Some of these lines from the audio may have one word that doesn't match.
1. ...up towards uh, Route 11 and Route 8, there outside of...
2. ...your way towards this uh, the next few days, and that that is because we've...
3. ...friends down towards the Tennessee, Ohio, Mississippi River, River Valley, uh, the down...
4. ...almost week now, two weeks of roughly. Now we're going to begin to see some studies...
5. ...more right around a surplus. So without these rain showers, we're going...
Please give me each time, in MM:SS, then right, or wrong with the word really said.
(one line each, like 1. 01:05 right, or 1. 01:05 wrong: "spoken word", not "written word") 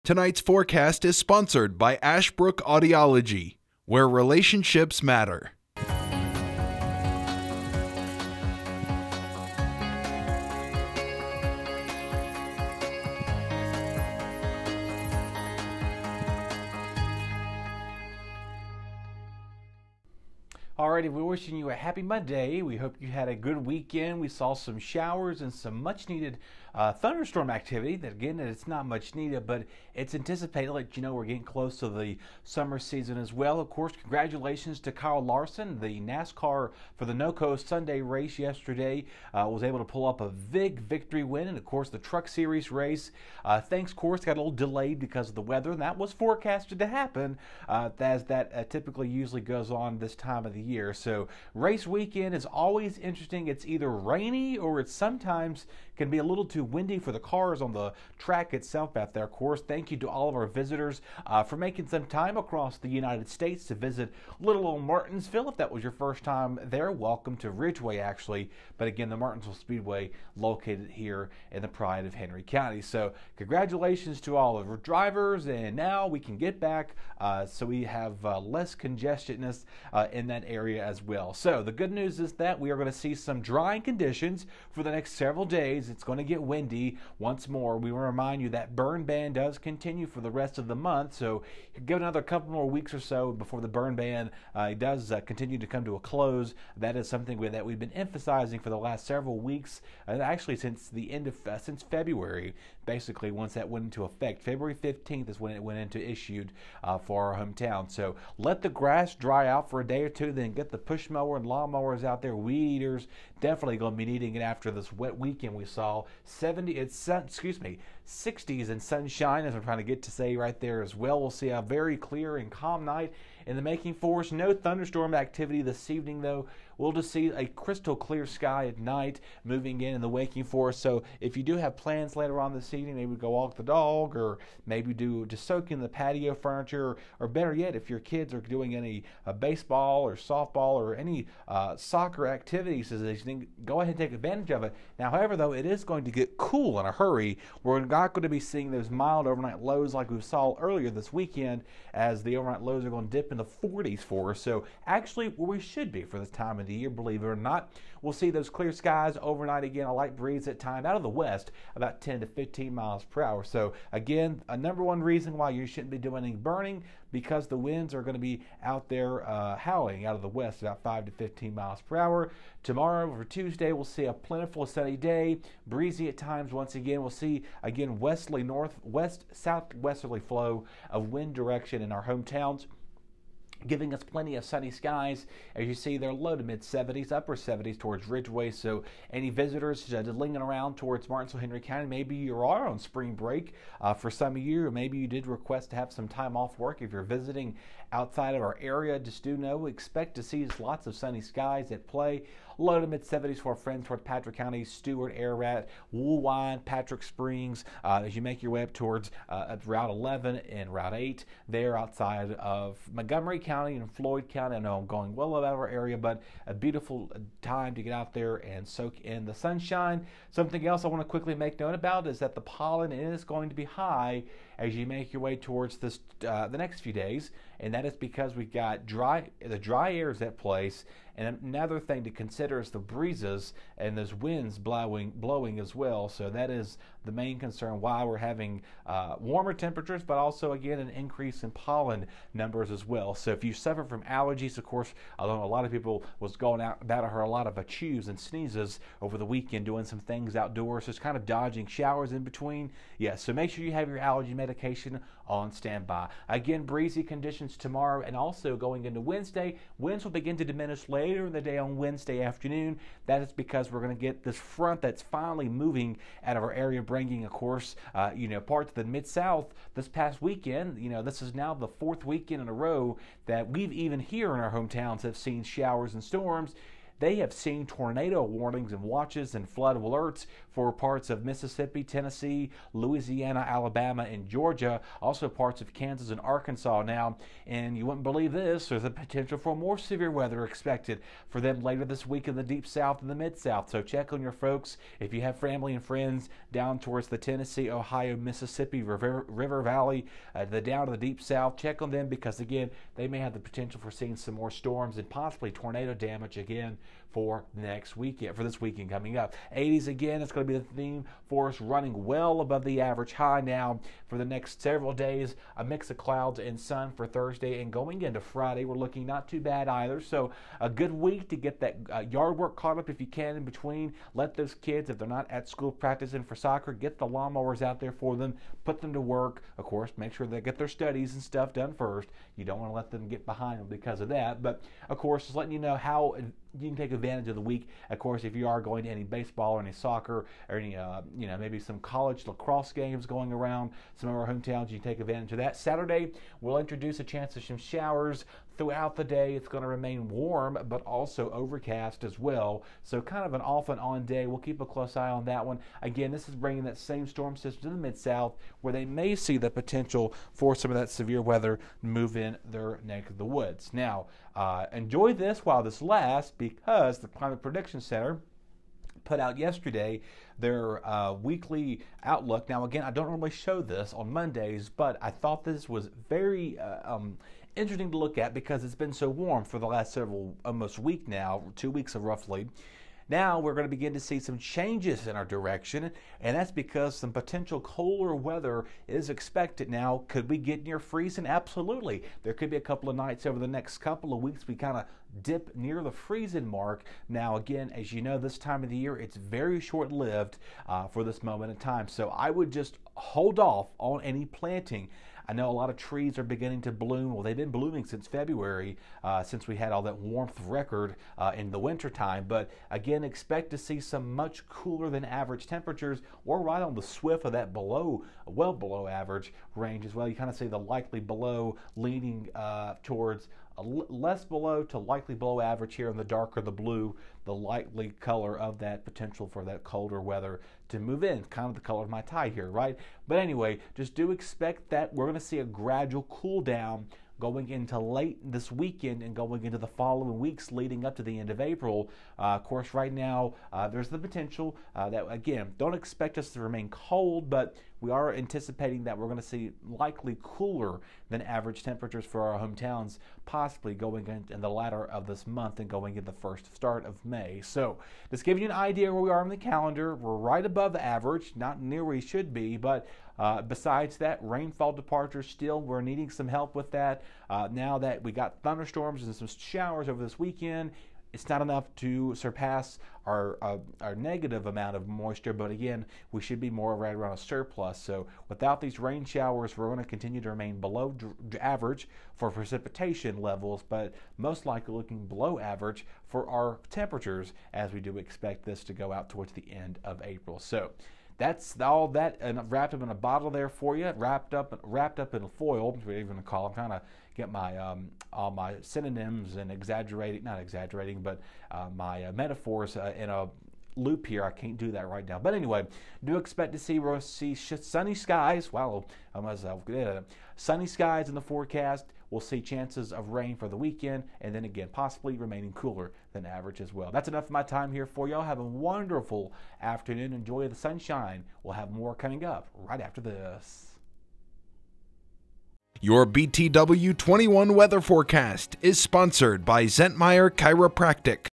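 1. 03:28 right
2. 03:45 right
3. 04:55 right
4. 06:20 wrong: "changes", not "studies"
5. 07:56 right.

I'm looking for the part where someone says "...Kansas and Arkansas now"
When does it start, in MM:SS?
04:45.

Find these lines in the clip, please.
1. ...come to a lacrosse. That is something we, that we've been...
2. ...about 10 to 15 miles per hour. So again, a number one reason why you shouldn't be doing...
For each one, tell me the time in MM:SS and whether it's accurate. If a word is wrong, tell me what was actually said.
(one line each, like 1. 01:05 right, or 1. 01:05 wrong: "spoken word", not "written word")
1. 01:35 wrong: "close", not "lacrosse"
2. 02:41 right.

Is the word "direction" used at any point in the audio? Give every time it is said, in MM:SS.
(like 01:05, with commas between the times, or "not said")
03:01, 06:25.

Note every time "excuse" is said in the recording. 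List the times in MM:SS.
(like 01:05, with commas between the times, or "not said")
01:57.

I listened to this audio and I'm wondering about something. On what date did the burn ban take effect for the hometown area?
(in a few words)
February 15th.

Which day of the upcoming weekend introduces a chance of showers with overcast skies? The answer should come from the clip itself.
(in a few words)
Saturday.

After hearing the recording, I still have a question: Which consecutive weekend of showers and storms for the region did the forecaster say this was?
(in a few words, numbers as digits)
fourth.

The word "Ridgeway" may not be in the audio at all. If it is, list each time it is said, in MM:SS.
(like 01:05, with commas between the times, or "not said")
01:07, 03:08.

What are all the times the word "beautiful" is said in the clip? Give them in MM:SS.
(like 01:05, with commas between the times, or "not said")
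03:36.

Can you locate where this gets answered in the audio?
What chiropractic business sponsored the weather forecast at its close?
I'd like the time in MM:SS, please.
08:49.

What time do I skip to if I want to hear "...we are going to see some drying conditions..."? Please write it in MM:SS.
01:22.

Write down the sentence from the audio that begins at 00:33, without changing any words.
Of course, congratulations to Kyle Larson.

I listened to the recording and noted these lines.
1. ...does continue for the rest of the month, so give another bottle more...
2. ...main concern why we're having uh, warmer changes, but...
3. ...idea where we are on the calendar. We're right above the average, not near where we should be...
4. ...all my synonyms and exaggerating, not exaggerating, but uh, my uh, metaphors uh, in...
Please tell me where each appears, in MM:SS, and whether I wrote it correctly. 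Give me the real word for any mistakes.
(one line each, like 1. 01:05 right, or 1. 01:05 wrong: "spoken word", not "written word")
1. 01:29 wrong: "couple", not "bottle"
2. 03:57 wrong: "temperatures", not "changes"
3. 07:38 right
4. 08:18 right.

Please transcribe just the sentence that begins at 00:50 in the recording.
So, race weekend is always interesting.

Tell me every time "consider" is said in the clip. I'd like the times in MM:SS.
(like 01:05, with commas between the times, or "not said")
03:52.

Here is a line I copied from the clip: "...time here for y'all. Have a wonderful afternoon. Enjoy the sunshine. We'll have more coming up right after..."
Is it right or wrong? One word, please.
right.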